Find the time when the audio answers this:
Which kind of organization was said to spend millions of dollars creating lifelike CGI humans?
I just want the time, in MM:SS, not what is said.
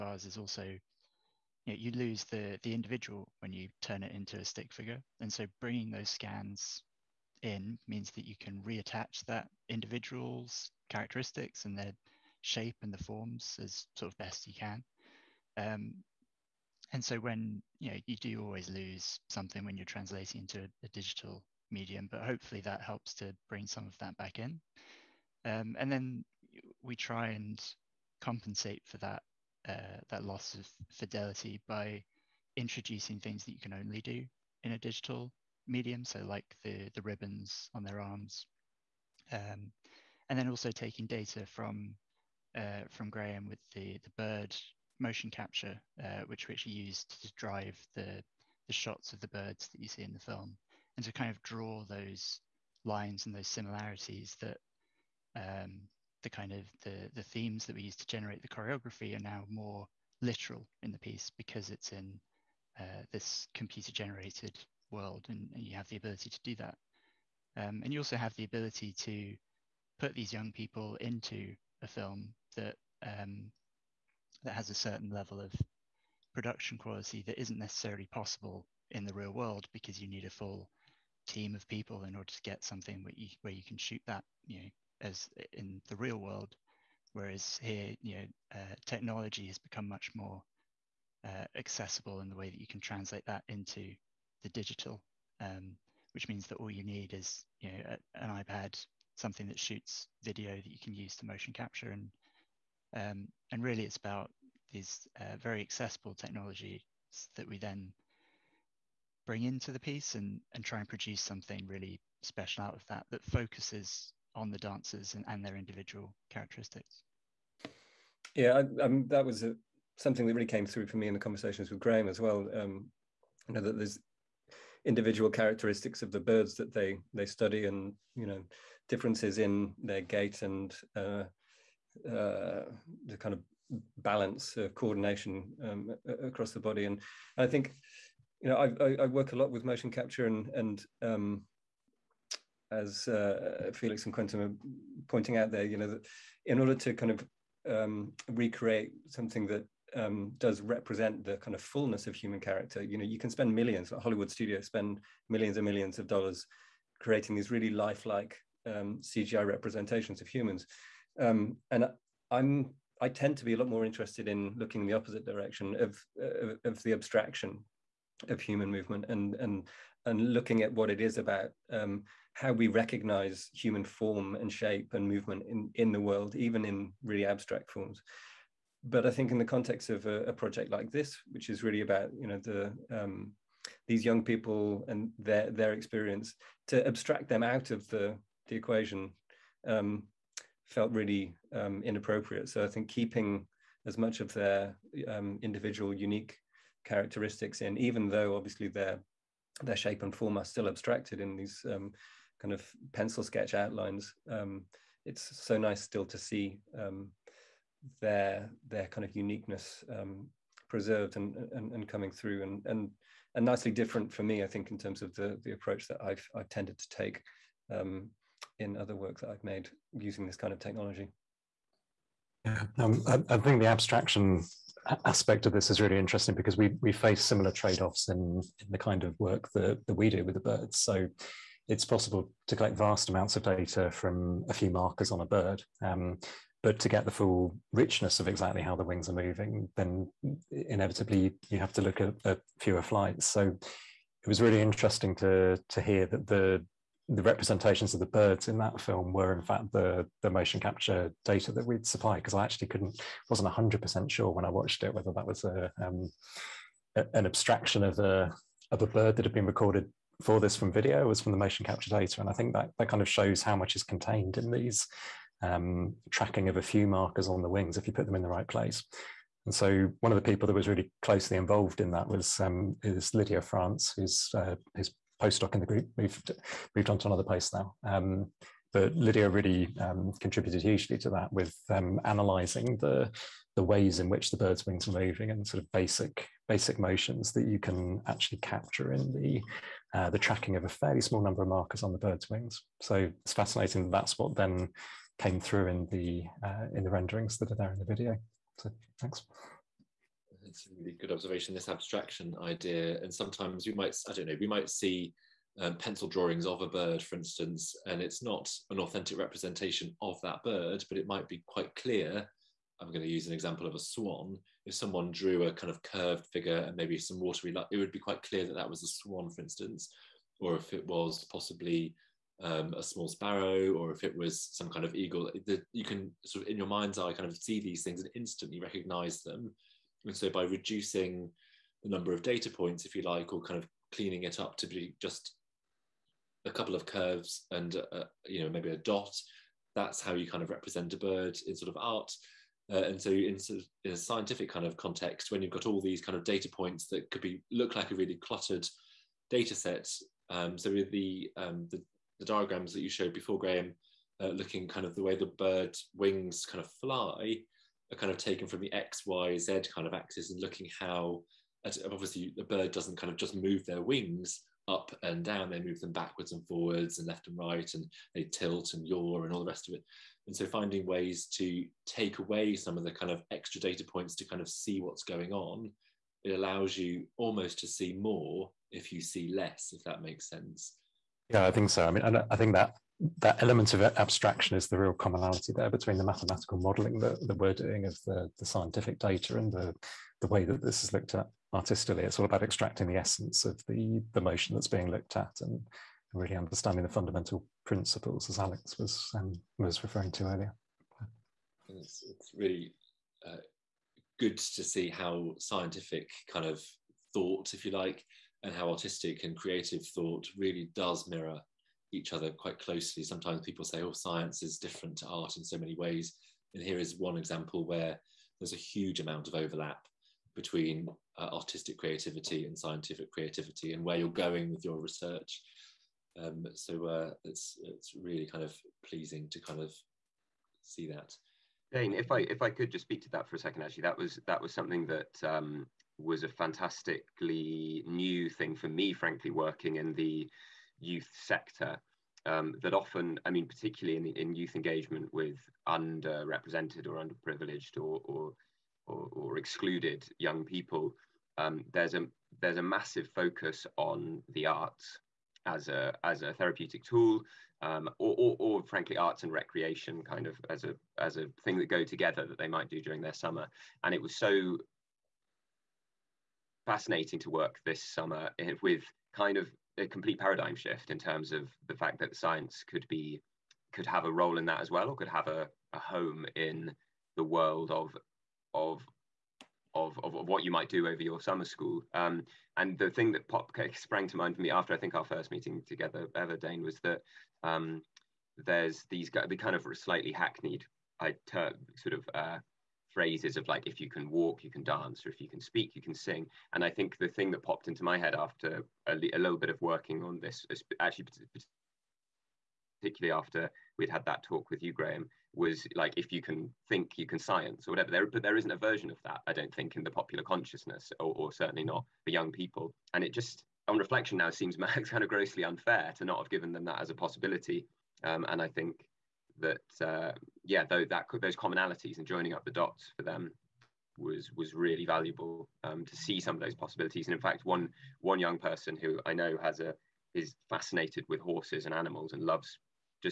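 02:34.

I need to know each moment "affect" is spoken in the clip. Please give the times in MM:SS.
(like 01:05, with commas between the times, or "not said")
not said.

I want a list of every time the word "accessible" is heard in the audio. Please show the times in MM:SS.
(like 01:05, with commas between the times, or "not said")
01:31, 01:45.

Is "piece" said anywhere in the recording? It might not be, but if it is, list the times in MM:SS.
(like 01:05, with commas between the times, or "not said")
01:00, 01:49.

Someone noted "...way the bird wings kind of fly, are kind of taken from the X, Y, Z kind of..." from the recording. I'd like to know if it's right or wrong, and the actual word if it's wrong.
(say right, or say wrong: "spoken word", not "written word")
right.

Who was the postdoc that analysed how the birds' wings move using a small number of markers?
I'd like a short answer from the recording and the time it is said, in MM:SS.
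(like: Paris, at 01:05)
Lydia France, at 04:33.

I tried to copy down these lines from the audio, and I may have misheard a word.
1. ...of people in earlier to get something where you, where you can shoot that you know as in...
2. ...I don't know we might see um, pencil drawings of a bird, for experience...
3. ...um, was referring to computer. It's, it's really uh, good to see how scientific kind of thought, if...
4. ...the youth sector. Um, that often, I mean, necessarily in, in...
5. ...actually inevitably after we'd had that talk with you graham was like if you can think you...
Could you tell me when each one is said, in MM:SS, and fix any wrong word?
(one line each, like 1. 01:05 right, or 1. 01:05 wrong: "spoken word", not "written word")
1. 01:21 wrong: "order", not "earlier"
2. 05:04 wrong: "instance", not "experience"
3. 06:39 wrong: "earlier", not "computer"
4. 07:19 wrong: "particularly", not "necessarily"
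5. 08:20 wrong: "particularly", not "inevitably".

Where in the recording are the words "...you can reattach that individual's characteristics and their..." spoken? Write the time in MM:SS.
00:08.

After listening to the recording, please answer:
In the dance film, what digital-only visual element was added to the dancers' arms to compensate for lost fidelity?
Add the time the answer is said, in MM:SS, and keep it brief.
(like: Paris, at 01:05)
ribbons, at 00:37.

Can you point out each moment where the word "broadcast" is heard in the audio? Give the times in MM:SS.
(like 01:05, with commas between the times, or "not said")
not said.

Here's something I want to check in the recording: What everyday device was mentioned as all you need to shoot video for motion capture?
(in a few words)
an iPad.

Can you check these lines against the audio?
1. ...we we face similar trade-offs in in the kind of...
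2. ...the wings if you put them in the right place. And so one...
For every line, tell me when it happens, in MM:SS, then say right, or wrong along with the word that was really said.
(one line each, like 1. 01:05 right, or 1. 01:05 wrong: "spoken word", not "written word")
1. 03:46 right
2. 04:27 right.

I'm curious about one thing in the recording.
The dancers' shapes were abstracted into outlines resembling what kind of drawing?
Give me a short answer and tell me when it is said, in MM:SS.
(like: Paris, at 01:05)
pencil sketch, at 03:22.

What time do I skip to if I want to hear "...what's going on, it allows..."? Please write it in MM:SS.
06:14.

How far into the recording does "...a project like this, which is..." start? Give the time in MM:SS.
03:00.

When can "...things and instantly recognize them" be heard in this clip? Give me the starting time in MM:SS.
05:27.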